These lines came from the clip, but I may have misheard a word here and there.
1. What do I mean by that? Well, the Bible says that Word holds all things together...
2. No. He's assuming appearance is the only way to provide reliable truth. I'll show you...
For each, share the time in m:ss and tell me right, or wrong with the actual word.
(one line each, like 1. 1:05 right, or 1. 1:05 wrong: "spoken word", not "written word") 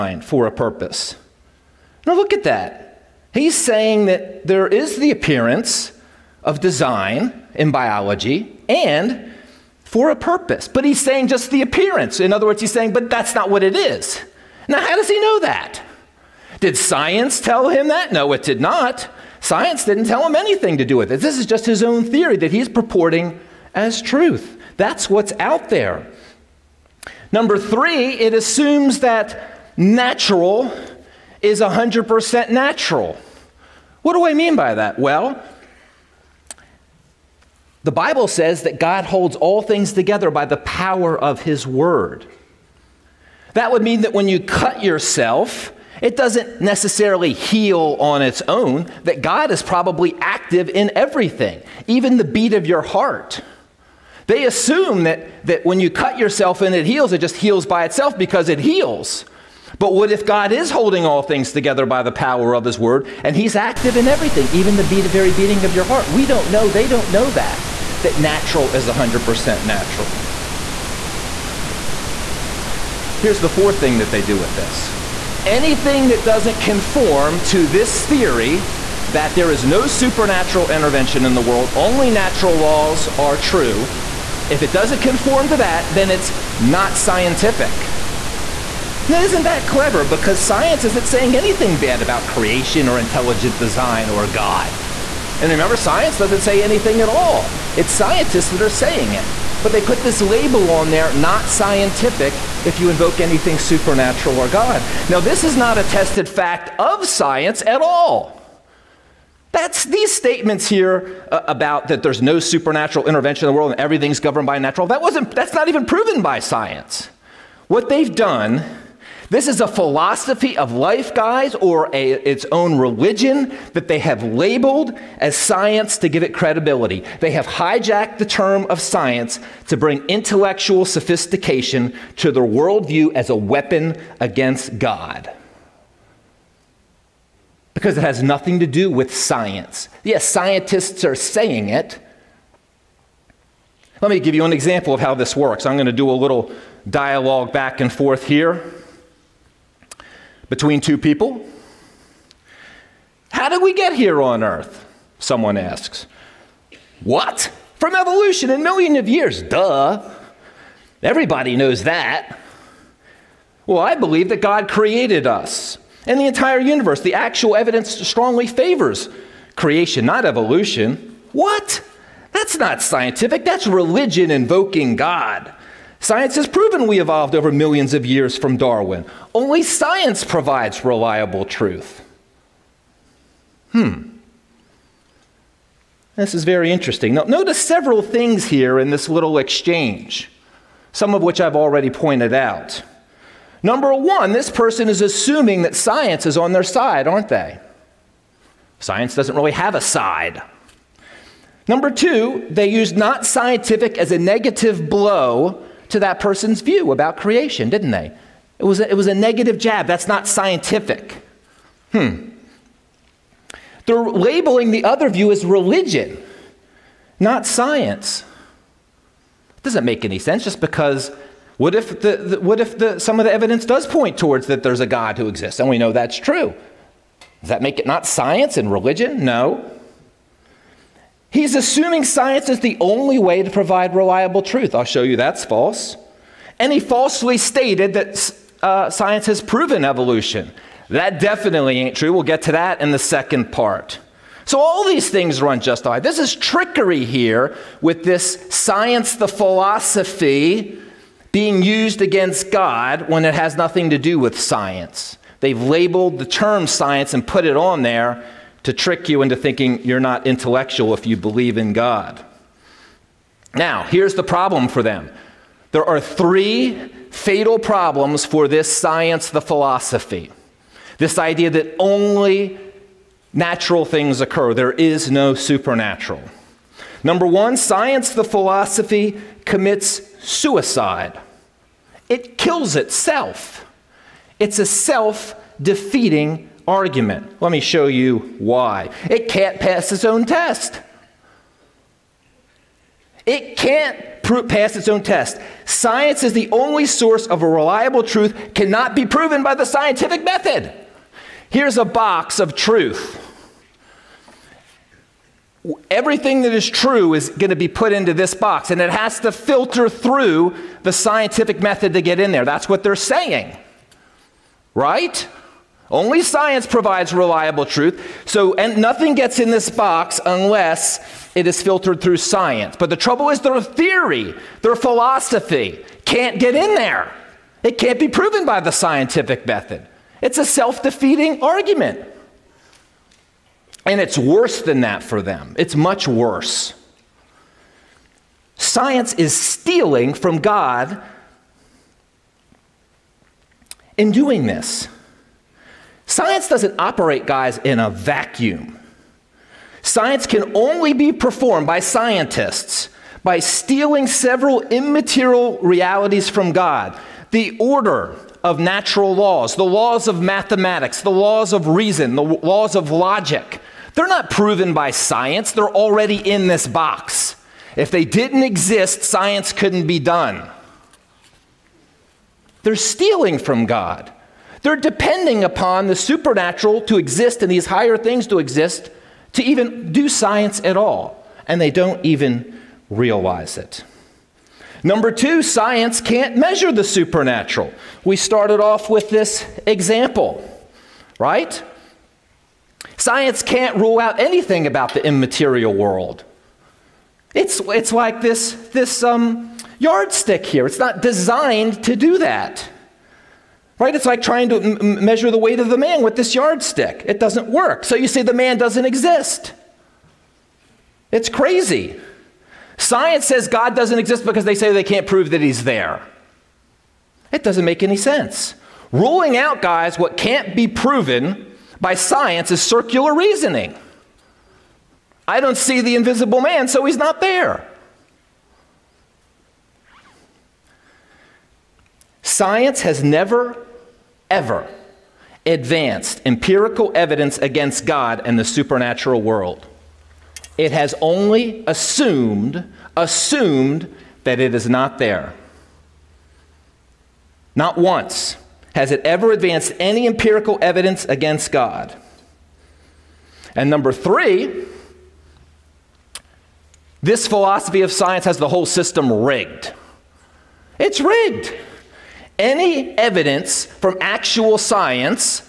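1. 0:34 wrong: "God", not "Word"
2. 3:49 wrong: "science", not "appearance".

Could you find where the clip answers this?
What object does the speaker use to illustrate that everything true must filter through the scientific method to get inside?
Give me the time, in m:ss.
5:01.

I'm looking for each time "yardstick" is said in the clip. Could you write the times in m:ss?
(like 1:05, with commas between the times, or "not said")
6:39, 6:46.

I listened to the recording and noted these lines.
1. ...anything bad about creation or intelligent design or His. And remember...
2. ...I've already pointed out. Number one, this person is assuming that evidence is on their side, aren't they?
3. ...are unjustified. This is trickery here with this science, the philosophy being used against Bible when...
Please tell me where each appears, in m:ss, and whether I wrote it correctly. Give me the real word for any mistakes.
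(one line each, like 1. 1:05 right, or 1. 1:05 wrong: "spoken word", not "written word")
1. 1:31 wrong: "God", not "His"
2. 3:11 wrong: "science", not "evidence"
3. 4:05 wrong: "God", not "Bible".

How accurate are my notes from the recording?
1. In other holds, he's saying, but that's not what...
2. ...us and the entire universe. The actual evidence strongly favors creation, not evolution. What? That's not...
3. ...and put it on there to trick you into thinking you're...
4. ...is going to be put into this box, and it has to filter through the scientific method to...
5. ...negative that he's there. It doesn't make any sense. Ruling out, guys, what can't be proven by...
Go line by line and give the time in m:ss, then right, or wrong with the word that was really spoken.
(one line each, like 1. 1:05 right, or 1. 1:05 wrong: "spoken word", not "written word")
1. 0:12 wrong: "words", not "holds"
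2. 2:45 right
3. 4:17 right
4. 5:07 right
5. 6:55 wrong: "prove", not "negative".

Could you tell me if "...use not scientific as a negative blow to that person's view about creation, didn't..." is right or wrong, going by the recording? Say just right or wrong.
right.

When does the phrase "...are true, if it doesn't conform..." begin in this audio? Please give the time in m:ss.
1:23.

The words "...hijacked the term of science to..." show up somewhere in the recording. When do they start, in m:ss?
2:07.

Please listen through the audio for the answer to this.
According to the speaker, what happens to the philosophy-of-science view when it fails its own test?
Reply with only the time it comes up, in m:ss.
4:39.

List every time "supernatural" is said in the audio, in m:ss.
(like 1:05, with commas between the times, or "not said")
1:19, 1:43, 1:52, 4:35, 6:15, 6:26, 7:18.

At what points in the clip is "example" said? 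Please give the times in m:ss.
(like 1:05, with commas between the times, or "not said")
2:24, 6:29.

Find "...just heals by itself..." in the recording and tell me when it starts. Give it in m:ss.
0:57.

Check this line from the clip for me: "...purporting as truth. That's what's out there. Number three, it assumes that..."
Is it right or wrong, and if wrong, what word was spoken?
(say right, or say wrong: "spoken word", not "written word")
right.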